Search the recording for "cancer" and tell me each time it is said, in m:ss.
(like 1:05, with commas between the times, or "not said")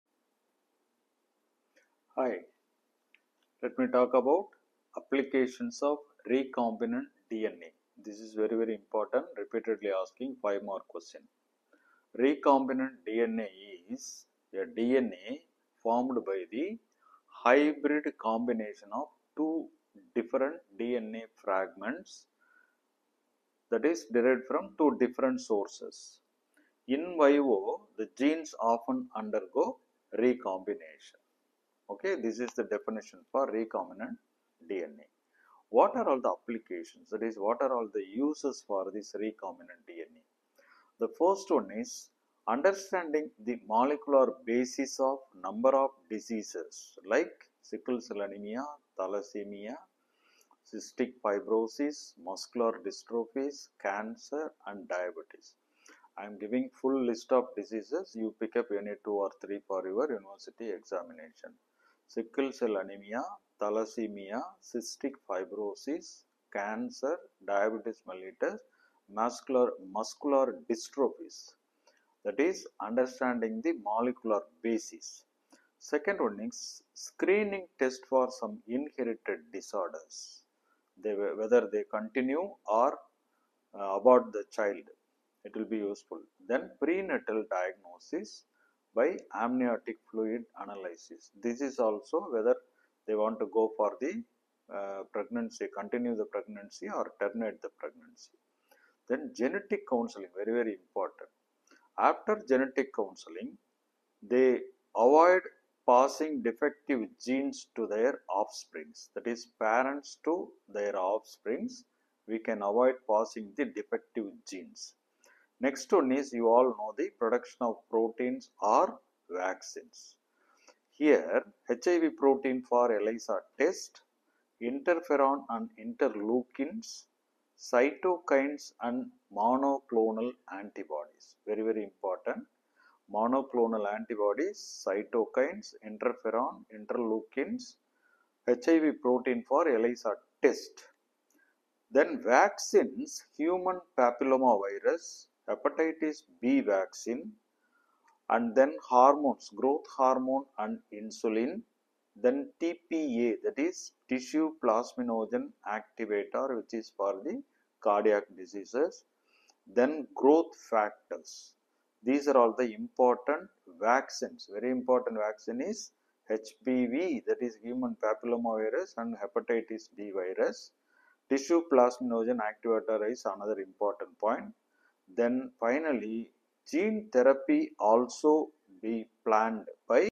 0:53, 1:06.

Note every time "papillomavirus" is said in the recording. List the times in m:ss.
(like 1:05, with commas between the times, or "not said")
2:23, 2:48.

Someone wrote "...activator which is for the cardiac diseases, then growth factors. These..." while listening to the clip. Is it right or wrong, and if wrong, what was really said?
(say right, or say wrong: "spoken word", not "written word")
right.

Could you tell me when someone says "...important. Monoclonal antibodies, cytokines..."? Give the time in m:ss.
2:11.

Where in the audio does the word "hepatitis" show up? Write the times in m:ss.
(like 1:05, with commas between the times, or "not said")
2:25, 2:49.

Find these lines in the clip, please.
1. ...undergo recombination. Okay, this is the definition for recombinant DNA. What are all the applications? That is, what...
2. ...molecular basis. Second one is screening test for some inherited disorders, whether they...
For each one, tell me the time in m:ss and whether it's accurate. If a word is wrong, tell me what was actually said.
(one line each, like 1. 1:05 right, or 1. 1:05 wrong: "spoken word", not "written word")
1. 0:29 right
2. 1:13 right.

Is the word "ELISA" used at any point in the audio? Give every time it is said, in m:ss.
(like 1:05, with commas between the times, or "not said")
2:02, 2:19.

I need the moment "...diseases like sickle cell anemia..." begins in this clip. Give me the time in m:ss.
0:46.